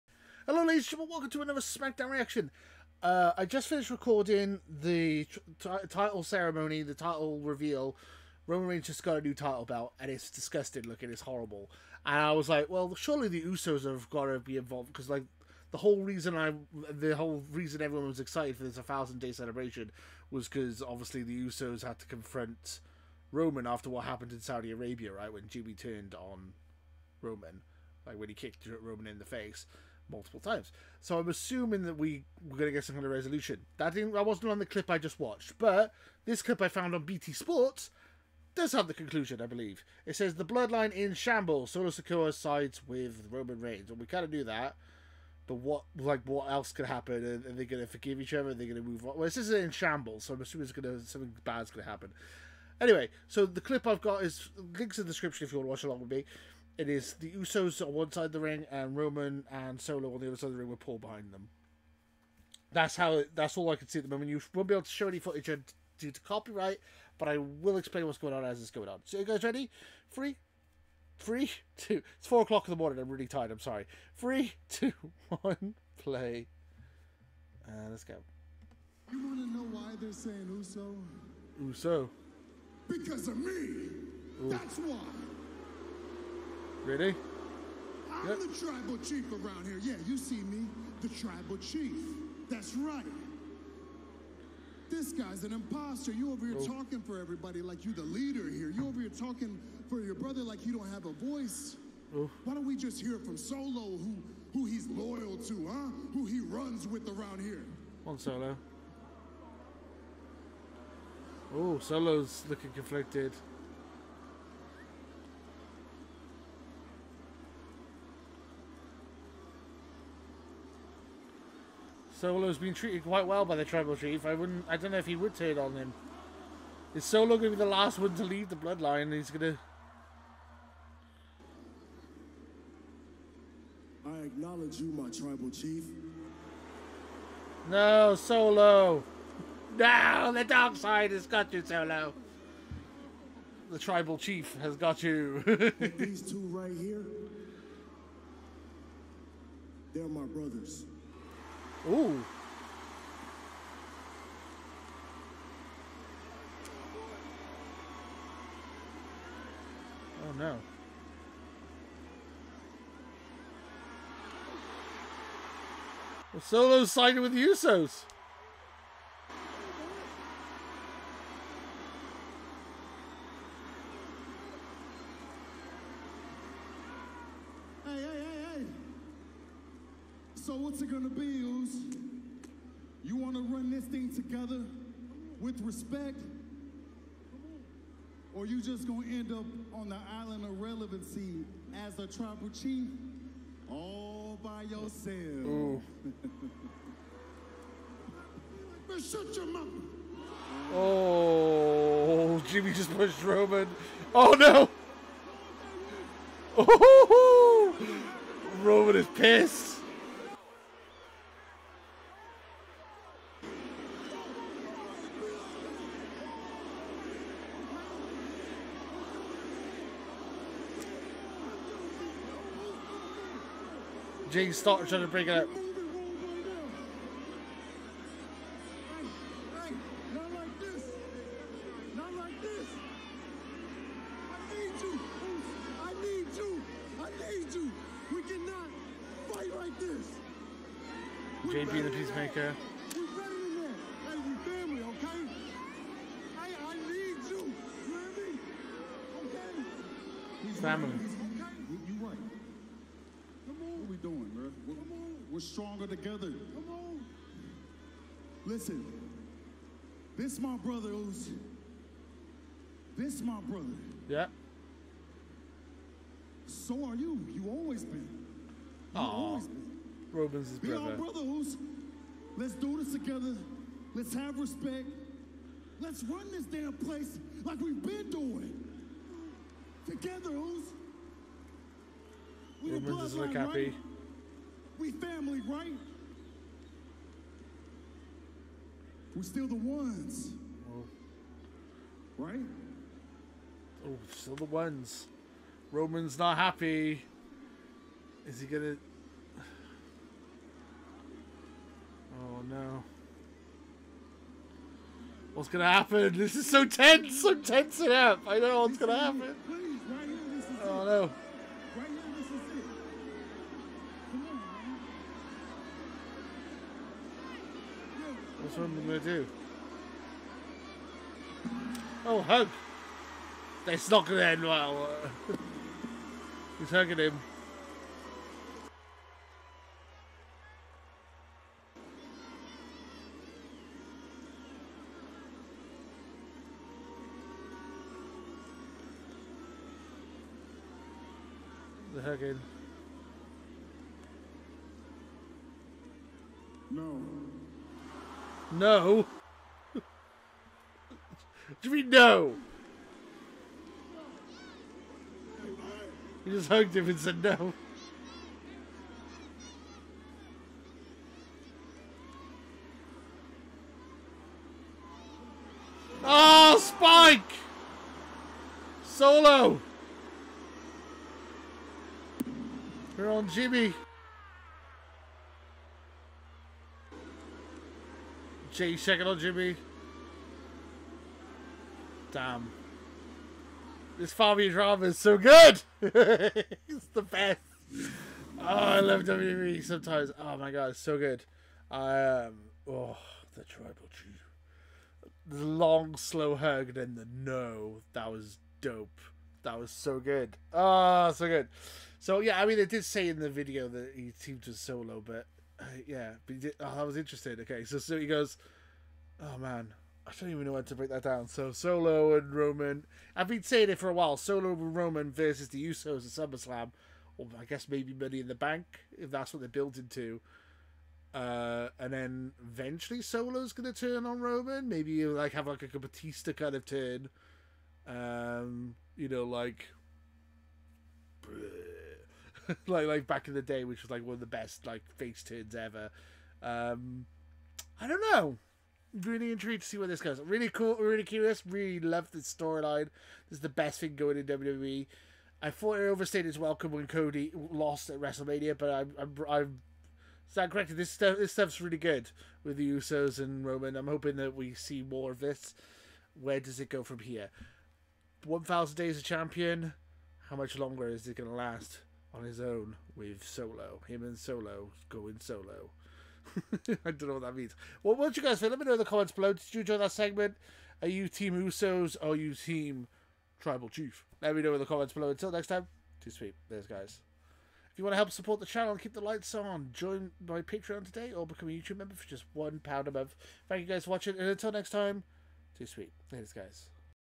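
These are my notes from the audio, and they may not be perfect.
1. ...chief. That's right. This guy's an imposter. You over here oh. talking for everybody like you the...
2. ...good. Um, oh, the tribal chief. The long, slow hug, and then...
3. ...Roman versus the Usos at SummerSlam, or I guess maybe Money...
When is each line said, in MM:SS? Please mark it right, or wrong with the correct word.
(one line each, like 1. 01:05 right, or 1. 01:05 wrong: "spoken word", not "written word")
1. 01:31 right
2. 06:30 right
3. 06:54 right.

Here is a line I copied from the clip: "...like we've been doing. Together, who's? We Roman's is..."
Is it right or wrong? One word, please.
right.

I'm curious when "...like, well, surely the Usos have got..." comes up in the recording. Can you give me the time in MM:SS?
00:12.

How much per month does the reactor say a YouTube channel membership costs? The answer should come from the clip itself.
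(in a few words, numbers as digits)
1 pound.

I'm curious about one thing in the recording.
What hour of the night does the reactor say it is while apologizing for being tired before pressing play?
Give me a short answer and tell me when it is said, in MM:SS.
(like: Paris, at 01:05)
4 o'clock in the morning, at 01:12.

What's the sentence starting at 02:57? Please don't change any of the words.
Hey, hey, hey, so what's it gonna be?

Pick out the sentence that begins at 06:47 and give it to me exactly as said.
Okay, so so he goes, oh man, I don't even know when to break that down.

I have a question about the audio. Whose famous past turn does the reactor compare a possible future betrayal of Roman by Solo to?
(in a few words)
Batista.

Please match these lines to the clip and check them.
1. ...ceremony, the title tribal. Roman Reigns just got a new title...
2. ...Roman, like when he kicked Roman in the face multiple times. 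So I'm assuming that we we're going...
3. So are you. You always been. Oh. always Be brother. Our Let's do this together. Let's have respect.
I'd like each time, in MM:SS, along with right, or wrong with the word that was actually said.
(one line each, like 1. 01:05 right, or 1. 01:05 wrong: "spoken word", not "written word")
1. 00:06 wrong: "reveal", not "tribal"
2. 00:27 right
3. 04:26 right.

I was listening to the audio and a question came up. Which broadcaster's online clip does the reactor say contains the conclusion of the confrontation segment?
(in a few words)
BT Sports.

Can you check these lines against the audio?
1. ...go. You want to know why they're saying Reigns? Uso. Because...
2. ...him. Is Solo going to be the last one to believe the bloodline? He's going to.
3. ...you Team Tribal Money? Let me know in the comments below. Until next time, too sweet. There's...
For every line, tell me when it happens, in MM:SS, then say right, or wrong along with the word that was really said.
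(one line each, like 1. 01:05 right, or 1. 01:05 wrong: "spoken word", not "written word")
1. 01:18 wrong: "Uso", not "Reigns"
2. 02:05 wrong: "leave", not "believe"
3. 07:52 wrong: "Chief", not "Money".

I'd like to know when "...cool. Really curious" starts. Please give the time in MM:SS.
07:20.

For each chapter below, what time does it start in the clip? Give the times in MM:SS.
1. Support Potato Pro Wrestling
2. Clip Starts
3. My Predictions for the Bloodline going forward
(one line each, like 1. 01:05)
1. 07:56
2. 01:16
3. 06:30.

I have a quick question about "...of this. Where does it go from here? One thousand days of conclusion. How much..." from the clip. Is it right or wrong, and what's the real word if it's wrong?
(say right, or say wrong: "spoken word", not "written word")
wrong: "champion", not "conclusion".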